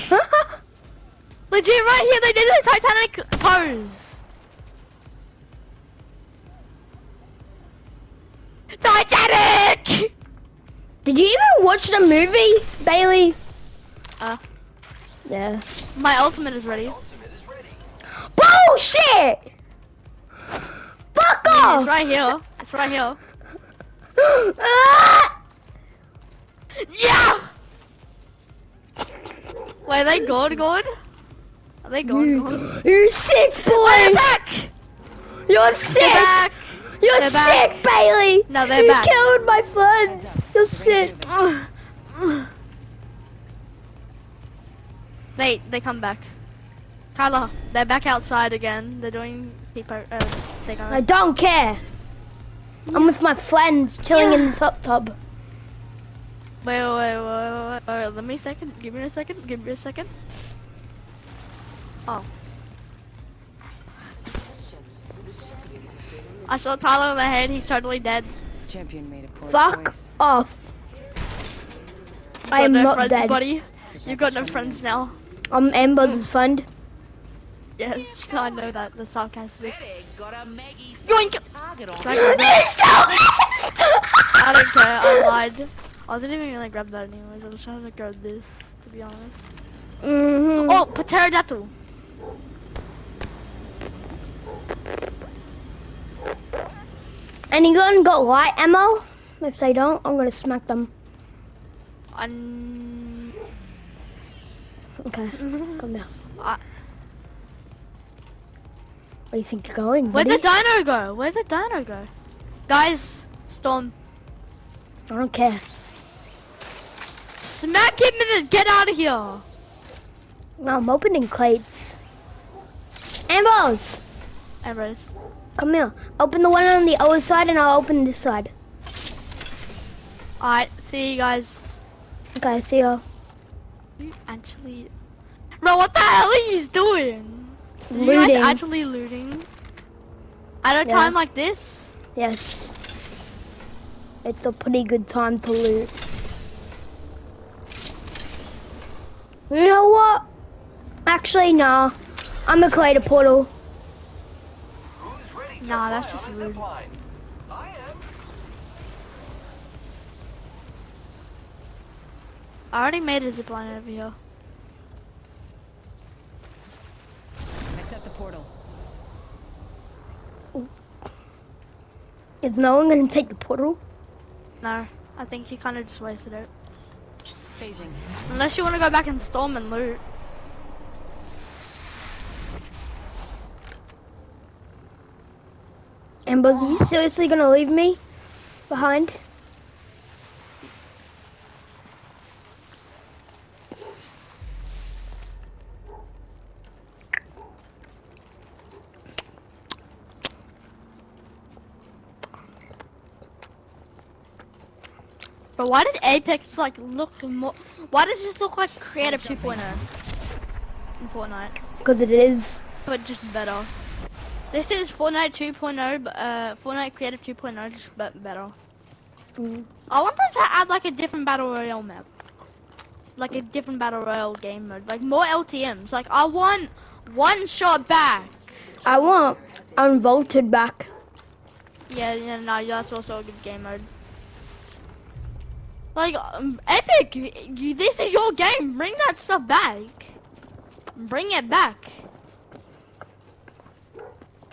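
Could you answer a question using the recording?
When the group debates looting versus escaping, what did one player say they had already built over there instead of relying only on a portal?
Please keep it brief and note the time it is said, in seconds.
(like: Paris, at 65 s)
zipline, at 163 s.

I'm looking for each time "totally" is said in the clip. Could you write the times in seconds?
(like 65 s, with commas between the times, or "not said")
67 s.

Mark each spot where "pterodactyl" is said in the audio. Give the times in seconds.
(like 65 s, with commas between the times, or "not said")
91 s.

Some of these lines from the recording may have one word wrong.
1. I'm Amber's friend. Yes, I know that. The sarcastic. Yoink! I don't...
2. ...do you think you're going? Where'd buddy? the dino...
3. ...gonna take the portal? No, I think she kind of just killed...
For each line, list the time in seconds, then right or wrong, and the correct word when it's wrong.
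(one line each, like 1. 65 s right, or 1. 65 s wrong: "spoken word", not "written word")
1. 75 s right
2. 109 s right
3. 172 s wrong: "wasted", not "killed".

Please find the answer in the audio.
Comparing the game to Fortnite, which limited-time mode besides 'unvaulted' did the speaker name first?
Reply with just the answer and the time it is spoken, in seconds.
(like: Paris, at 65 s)
one shot, at 227 s.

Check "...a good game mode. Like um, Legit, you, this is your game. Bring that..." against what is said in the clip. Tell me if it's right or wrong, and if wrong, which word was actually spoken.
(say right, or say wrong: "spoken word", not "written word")
wrong: "Epic", not "Legit".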